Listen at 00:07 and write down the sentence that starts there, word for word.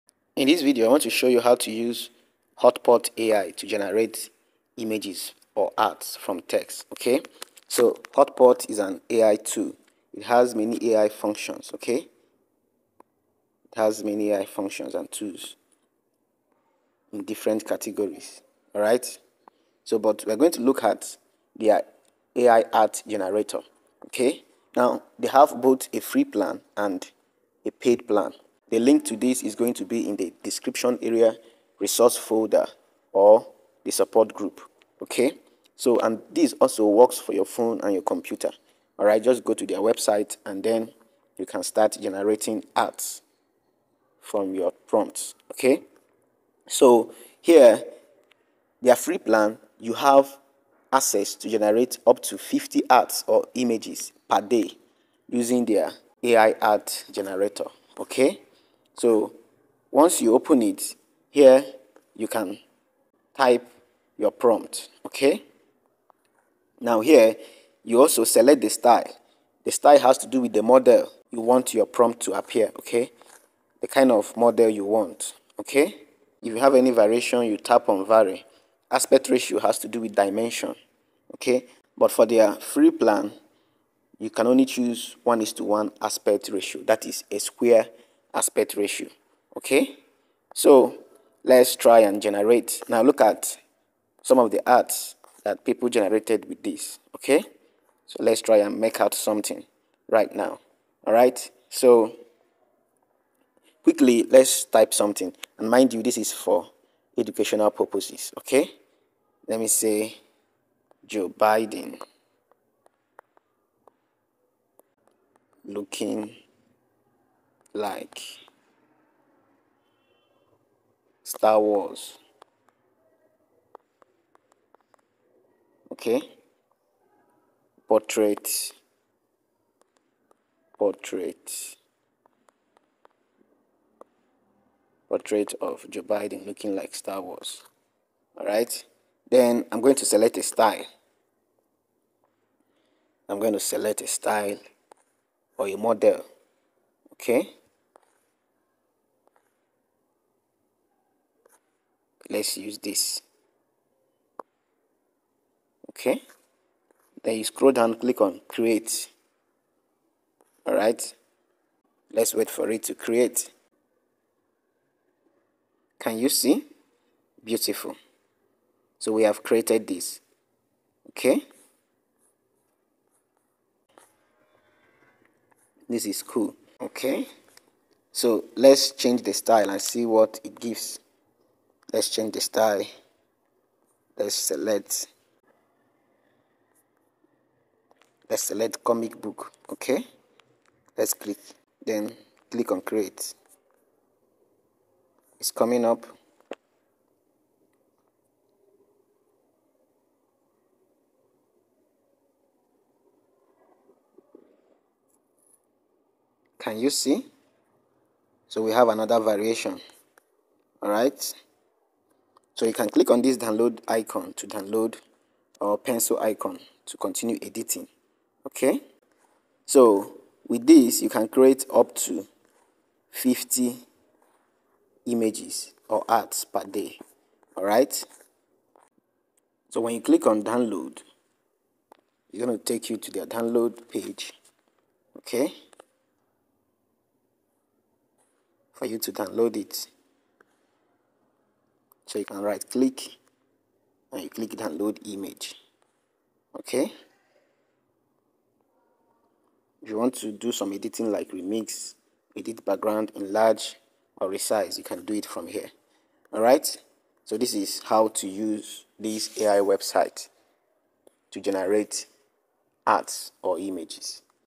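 So Hotpot is an AI tool.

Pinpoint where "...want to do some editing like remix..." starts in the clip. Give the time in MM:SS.
04:09.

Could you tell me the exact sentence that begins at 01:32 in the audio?
Now look at some of the arts that people generated with this.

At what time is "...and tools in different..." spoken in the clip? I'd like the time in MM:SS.
00:14.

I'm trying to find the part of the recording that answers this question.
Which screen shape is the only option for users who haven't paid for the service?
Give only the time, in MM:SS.
01:25.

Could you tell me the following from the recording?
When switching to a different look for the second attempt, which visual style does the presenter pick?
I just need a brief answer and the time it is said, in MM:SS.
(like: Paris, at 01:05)
Comic book, at 03:08.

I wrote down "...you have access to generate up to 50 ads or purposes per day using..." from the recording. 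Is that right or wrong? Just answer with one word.
wrong.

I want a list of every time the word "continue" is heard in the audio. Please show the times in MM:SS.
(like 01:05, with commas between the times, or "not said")
03:36.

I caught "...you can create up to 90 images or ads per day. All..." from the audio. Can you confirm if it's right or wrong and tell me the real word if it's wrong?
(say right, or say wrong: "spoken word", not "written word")
wrong: "50", not "90".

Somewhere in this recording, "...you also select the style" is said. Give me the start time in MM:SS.
01:07.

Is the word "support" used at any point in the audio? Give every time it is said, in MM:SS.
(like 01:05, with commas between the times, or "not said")
00:33.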